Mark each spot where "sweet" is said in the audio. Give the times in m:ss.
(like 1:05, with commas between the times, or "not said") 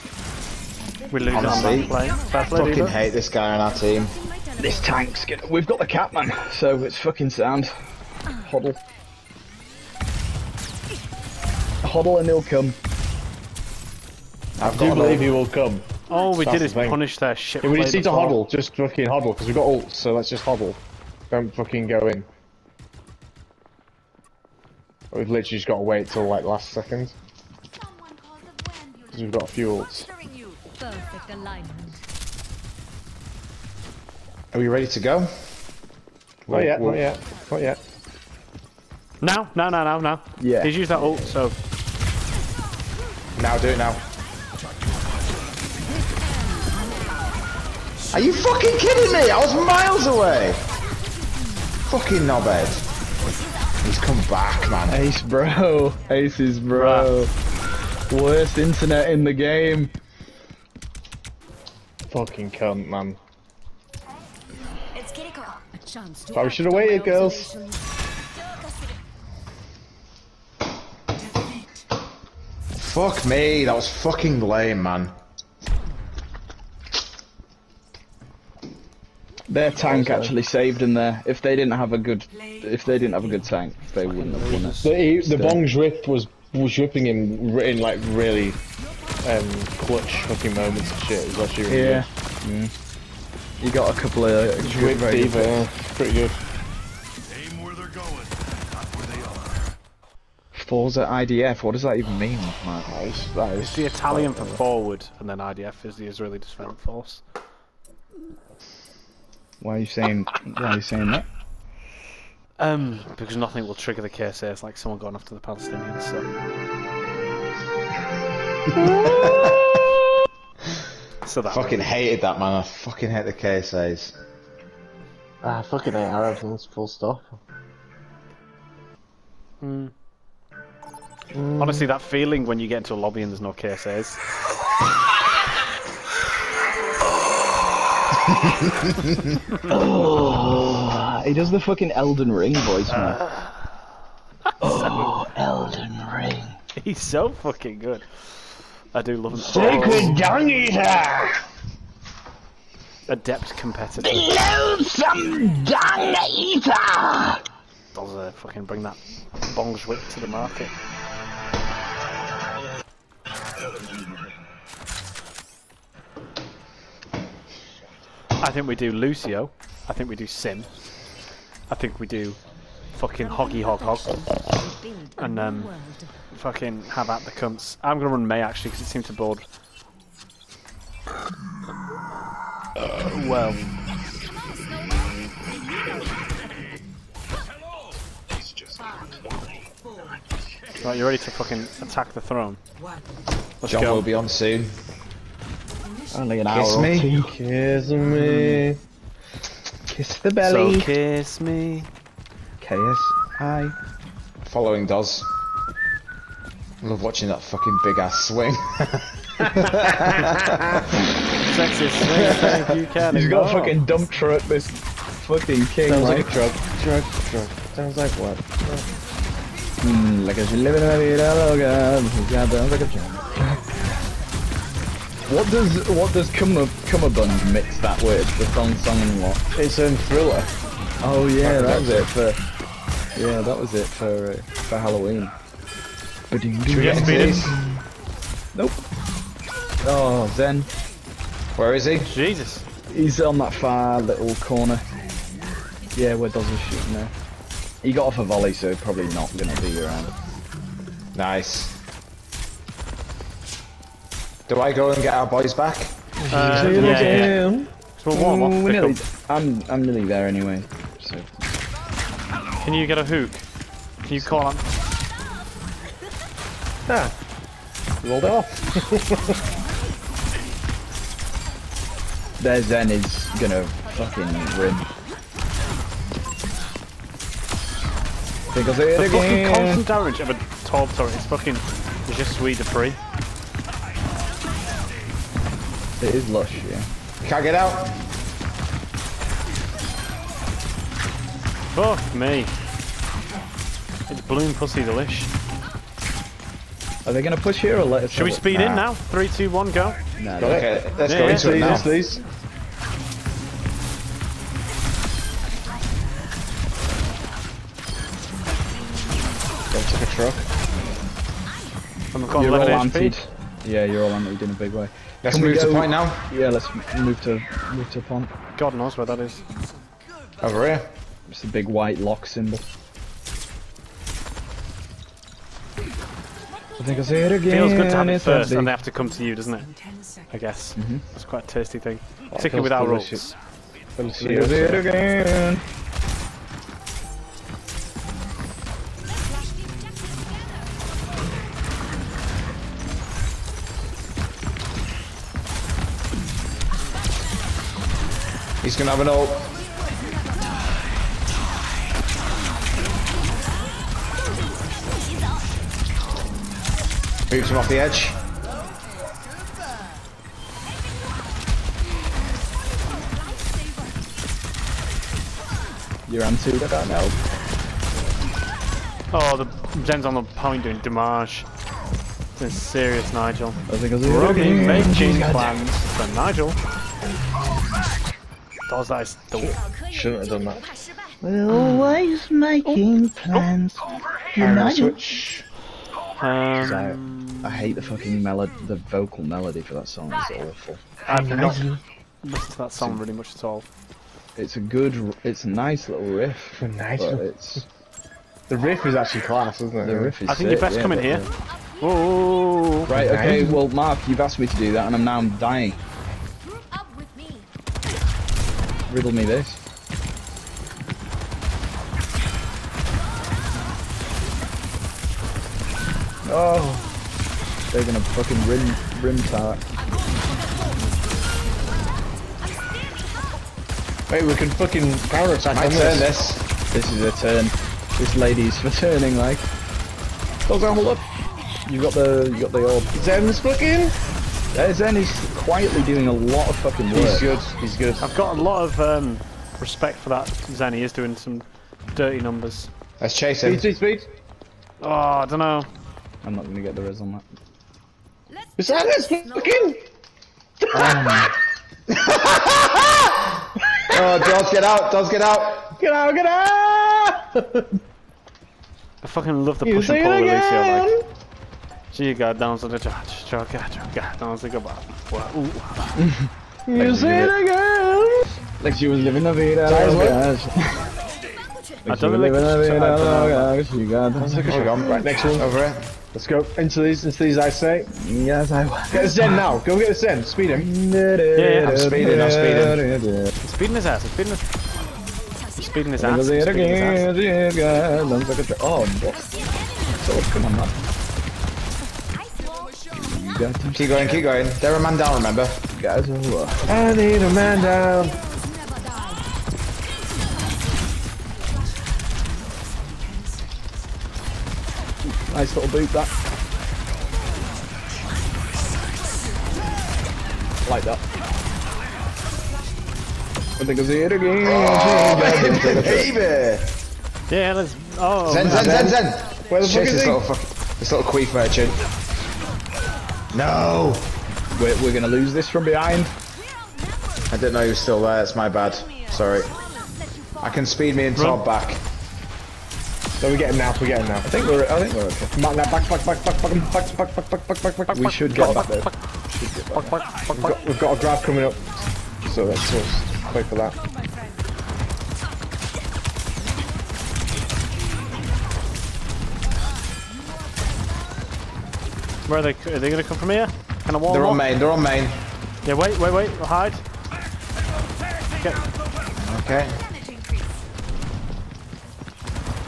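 4:42.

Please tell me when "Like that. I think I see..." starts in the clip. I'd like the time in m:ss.
8:30.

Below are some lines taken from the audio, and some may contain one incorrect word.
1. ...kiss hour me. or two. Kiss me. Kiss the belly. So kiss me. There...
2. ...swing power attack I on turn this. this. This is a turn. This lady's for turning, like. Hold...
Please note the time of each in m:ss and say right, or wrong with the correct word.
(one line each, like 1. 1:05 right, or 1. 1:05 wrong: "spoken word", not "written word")
1. 3:16 right
2. 7:04 wrong: "fucking", not "swing".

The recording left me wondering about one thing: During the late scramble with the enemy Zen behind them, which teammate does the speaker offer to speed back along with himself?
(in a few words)
Todd.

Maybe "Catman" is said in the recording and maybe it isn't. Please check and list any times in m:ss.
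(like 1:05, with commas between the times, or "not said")
0:05.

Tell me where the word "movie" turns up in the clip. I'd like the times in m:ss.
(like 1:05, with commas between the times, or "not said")
2:01.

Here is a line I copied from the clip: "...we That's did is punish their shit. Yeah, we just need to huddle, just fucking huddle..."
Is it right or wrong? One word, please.
right.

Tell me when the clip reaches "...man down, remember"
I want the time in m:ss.
8:14.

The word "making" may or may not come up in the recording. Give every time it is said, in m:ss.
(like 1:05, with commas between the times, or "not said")
6:14, 6:22.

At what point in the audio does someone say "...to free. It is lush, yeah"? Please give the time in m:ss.
4:42.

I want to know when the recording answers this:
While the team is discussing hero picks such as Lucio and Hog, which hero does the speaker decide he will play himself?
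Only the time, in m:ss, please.
2:58.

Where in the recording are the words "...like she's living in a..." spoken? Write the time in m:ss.
3:40.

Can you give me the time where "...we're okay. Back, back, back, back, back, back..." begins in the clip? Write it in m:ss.
8:54.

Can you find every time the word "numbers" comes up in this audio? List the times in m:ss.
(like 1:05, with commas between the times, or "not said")
7:22.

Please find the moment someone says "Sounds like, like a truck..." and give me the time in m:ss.
3:35.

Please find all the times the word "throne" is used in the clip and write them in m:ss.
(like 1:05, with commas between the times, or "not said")
3:12.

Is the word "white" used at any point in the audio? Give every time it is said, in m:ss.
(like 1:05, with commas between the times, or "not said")
5:21.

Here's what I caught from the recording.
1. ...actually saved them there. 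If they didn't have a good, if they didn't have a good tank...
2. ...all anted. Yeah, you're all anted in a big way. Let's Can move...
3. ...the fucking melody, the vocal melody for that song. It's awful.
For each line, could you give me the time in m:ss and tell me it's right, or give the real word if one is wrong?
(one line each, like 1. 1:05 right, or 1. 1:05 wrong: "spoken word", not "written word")
1. 1:20 right
2. 5:12 right
3. 6:27 right.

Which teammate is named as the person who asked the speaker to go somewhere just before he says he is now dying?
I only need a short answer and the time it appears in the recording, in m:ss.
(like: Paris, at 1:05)
Mark, at 6:43.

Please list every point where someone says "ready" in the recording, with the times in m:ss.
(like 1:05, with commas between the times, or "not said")
0:34, 3:11.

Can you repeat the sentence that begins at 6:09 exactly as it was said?
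Oh, the Zen's on the point doing damage.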